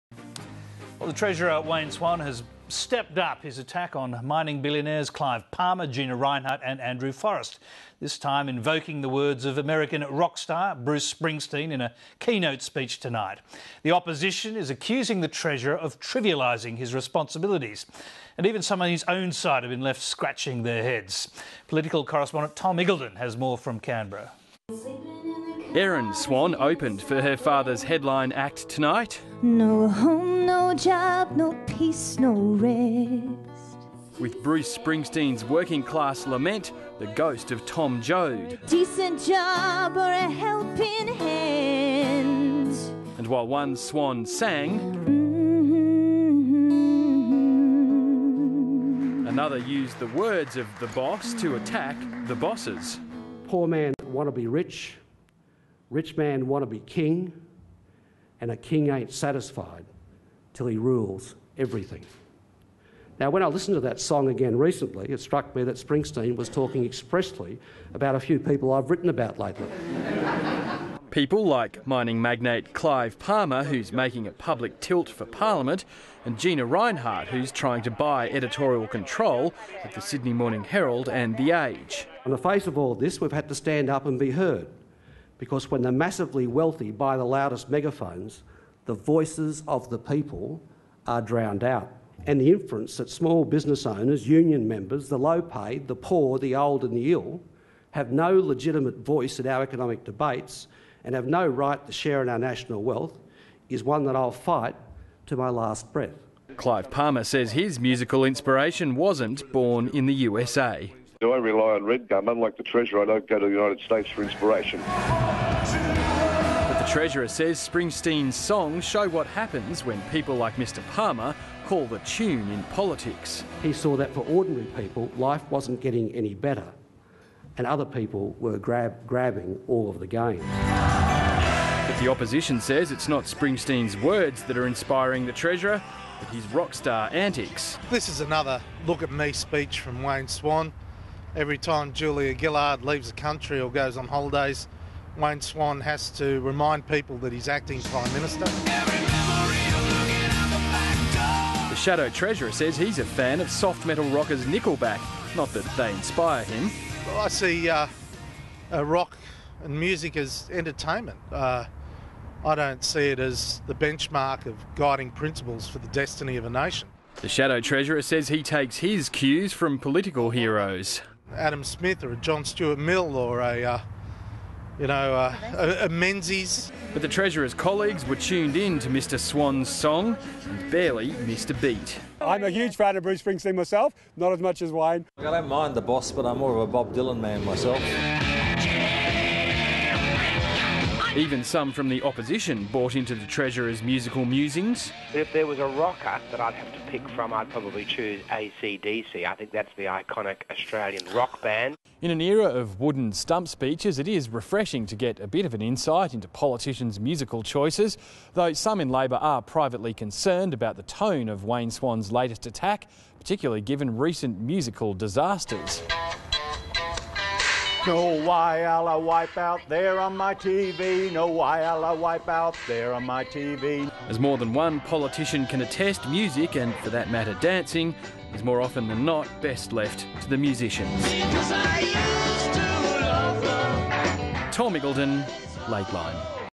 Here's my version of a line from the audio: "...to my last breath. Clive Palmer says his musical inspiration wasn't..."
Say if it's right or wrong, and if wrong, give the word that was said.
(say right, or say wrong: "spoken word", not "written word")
right.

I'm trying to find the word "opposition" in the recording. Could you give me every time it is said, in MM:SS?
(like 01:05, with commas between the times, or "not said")
00:13, 02:12, 03:12.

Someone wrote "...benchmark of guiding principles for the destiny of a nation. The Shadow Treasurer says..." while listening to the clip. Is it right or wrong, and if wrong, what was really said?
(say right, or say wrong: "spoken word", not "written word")
right.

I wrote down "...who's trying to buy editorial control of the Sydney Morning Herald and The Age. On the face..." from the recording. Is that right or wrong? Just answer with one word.
right.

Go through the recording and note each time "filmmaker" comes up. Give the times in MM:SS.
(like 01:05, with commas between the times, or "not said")
not said.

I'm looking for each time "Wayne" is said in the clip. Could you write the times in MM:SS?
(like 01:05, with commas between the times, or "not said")
00:01, 02:20, 02:25, 03:04, 03:31.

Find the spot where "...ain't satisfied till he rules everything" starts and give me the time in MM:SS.
00:58.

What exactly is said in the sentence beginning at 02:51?
Adam Smith or a John Stuart Mill or a, uh, you know, uh, a, a Menzies.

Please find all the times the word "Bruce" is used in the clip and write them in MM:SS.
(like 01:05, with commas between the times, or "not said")
00:10, 00:34, 03:03.